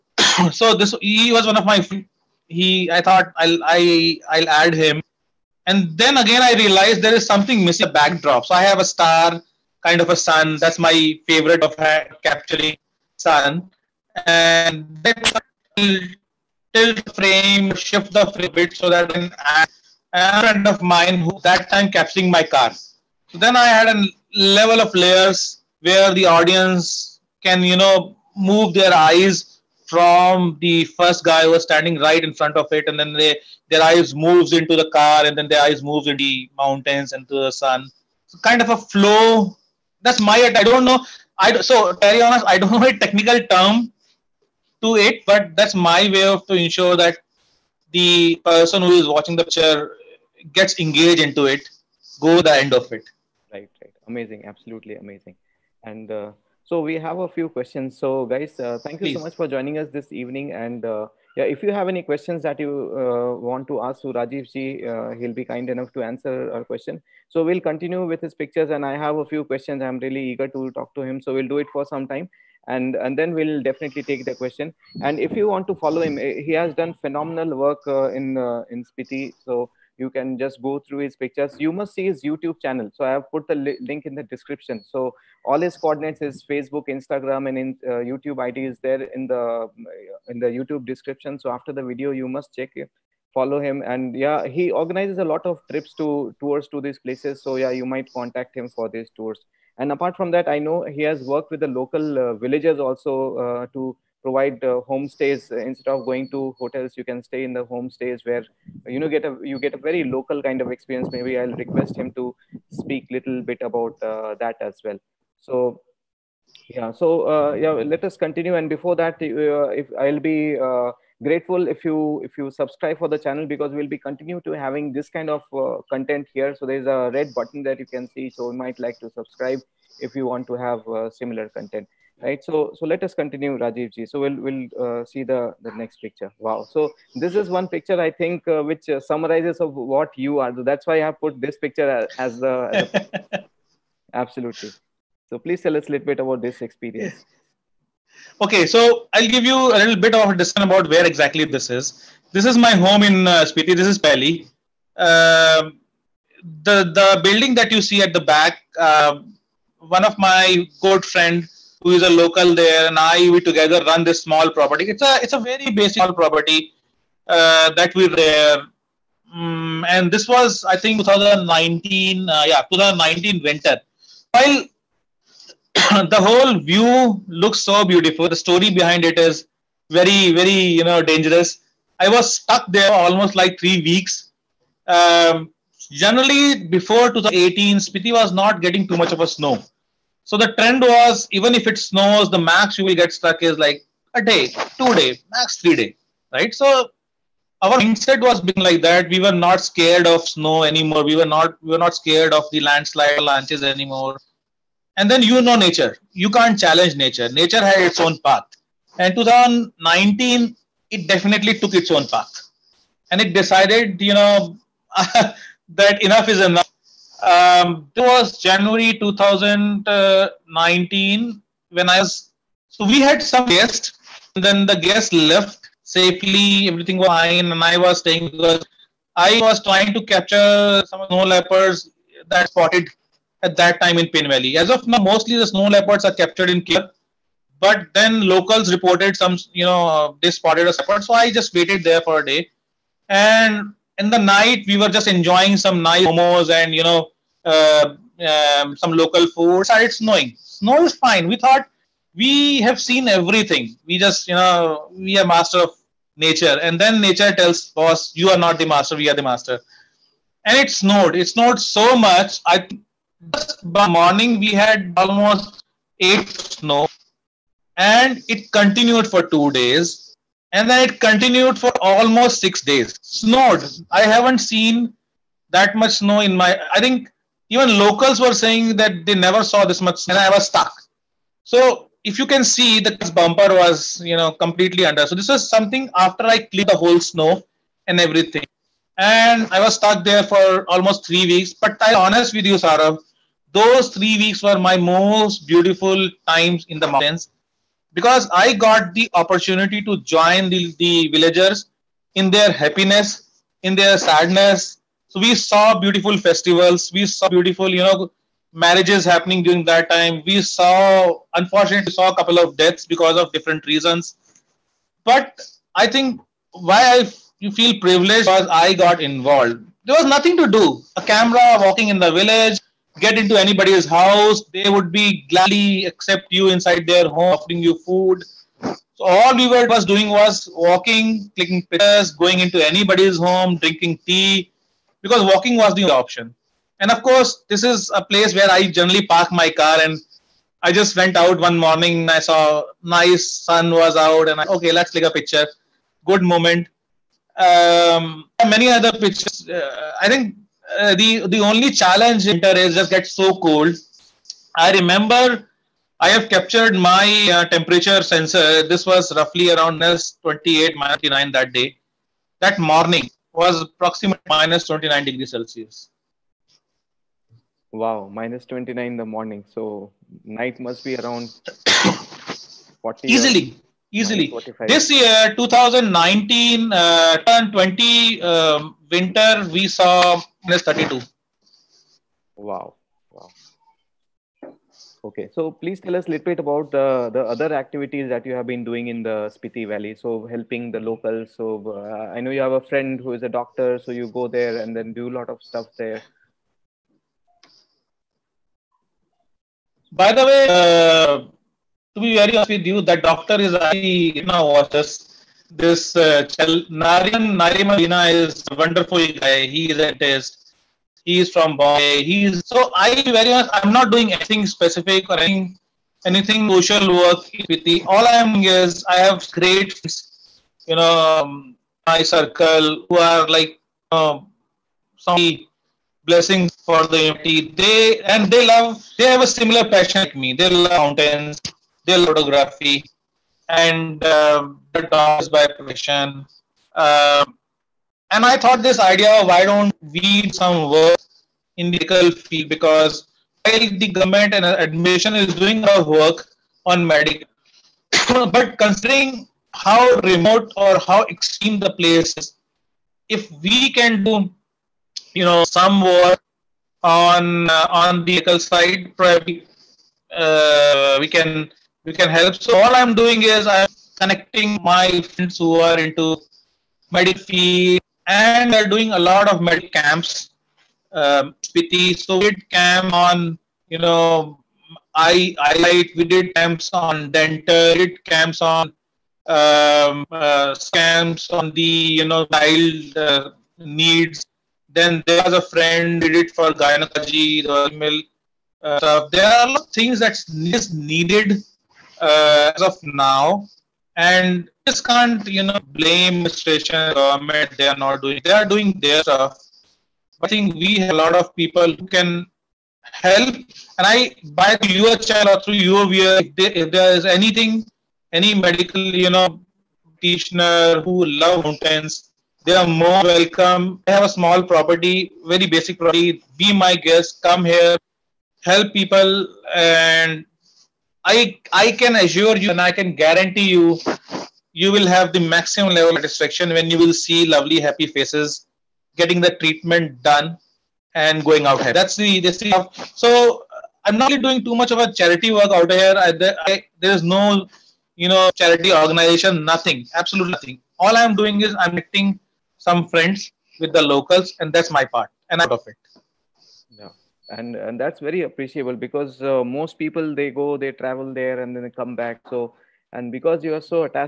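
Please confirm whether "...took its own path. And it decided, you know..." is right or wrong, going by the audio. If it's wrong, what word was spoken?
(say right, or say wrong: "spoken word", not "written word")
right.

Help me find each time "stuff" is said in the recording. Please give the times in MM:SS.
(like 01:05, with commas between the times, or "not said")
06:35, 08:08, 08:19.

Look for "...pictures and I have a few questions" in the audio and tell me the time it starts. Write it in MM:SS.
01:08.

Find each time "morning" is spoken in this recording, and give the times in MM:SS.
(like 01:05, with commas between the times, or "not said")
04:23, 05:41, 06:02, 06:09.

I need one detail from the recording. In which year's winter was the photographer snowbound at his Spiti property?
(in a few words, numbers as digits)
2019.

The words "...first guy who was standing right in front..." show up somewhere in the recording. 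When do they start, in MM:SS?
00:30.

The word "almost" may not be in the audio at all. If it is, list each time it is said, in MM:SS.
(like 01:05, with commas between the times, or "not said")
03:02, 04:24, 04:31, 04:50.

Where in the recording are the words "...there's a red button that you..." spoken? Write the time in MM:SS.
02:06.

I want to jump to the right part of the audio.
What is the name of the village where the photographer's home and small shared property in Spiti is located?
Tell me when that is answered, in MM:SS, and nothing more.
02:33.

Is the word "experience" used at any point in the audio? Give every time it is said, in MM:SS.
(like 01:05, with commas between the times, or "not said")
01:50, 02:26.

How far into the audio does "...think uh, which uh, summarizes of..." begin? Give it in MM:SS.
02:18.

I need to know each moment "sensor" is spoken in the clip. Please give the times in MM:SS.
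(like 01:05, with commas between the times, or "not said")
05:58.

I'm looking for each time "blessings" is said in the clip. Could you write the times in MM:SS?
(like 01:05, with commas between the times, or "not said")
07:06.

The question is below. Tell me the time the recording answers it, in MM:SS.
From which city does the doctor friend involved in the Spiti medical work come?
06:51.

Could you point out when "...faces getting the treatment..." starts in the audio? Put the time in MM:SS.
08:47.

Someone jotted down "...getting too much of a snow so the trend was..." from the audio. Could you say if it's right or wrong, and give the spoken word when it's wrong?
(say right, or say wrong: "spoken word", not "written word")
right.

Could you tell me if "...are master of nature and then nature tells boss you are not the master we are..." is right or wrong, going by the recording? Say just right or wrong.
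right.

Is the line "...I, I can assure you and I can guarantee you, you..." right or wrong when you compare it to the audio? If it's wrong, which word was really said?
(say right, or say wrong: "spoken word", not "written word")
right.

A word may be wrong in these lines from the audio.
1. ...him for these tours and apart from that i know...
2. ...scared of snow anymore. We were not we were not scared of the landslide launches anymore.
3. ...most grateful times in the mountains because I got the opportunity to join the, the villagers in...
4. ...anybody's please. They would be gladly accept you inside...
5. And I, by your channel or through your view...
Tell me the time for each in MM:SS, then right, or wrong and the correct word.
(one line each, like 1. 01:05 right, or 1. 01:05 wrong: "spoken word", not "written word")
1. 01:38 right
2. 03:19 right
3. 04:54 wrong: "beautiful", not "grateful"
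4. 05:23 wrong: "house", not "please"
5. 08:23 right.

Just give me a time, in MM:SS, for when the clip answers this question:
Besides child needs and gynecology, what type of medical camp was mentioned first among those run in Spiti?
07:57.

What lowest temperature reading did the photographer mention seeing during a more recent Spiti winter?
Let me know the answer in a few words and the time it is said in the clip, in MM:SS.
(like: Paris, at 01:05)
-32, at 06:20.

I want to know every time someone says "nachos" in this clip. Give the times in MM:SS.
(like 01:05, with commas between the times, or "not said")
not said.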